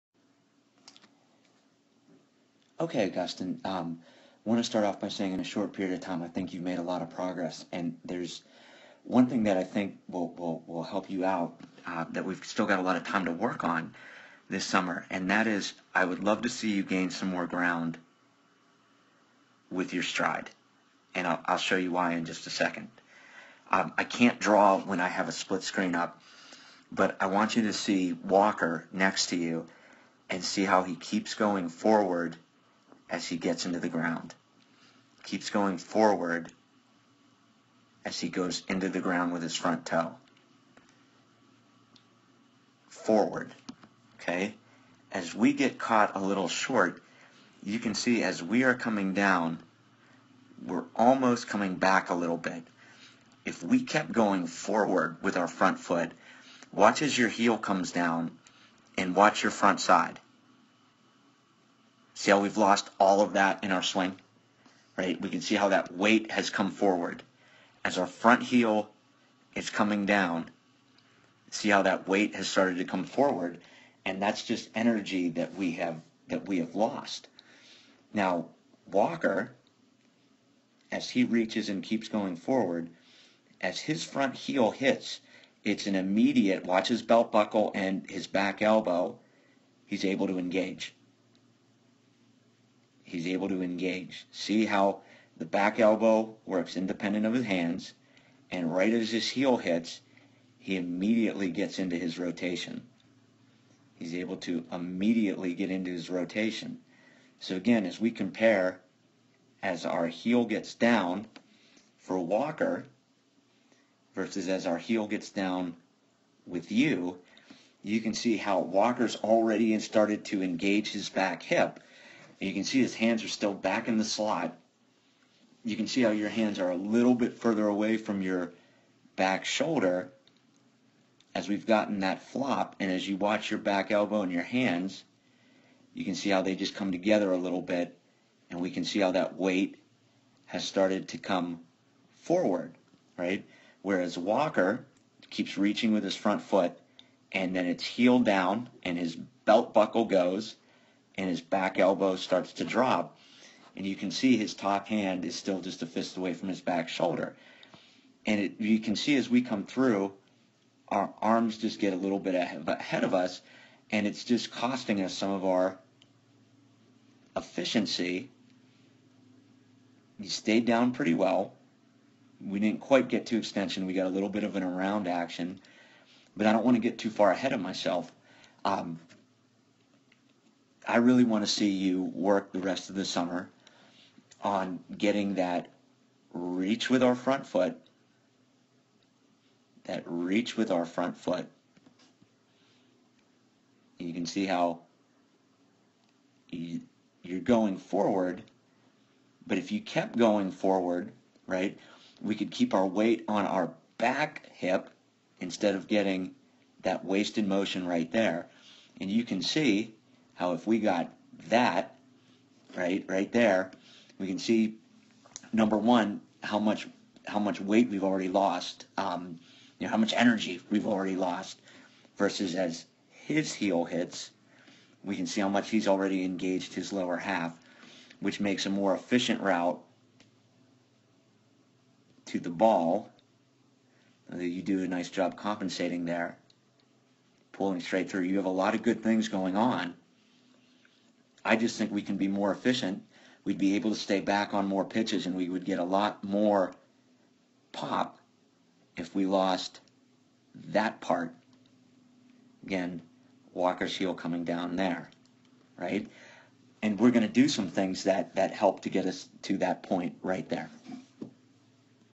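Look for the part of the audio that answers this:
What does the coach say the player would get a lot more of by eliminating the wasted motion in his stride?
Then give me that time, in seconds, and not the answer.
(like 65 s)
247 s.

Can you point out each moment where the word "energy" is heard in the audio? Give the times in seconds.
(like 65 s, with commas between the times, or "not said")
74 s, 220 s.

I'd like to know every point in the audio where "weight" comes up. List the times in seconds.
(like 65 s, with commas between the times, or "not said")
65 s, 72 s, 139 s, 202 s, 217 s.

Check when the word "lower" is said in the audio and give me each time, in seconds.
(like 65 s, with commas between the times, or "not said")
226 s.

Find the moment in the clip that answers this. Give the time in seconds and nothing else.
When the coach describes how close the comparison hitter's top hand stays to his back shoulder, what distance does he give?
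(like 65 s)
155 s.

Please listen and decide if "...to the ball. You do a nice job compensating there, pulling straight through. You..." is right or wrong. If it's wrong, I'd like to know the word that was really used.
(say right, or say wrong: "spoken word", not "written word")
right.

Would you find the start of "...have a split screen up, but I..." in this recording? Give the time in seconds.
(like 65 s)
25 s.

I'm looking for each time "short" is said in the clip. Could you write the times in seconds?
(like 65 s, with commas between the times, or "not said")
5 s, 46 s.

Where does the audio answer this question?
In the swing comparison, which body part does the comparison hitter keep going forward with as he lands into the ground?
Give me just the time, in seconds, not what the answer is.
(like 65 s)
39 s.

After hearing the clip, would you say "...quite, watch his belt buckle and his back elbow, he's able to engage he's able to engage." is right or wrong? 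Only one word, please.
wrong.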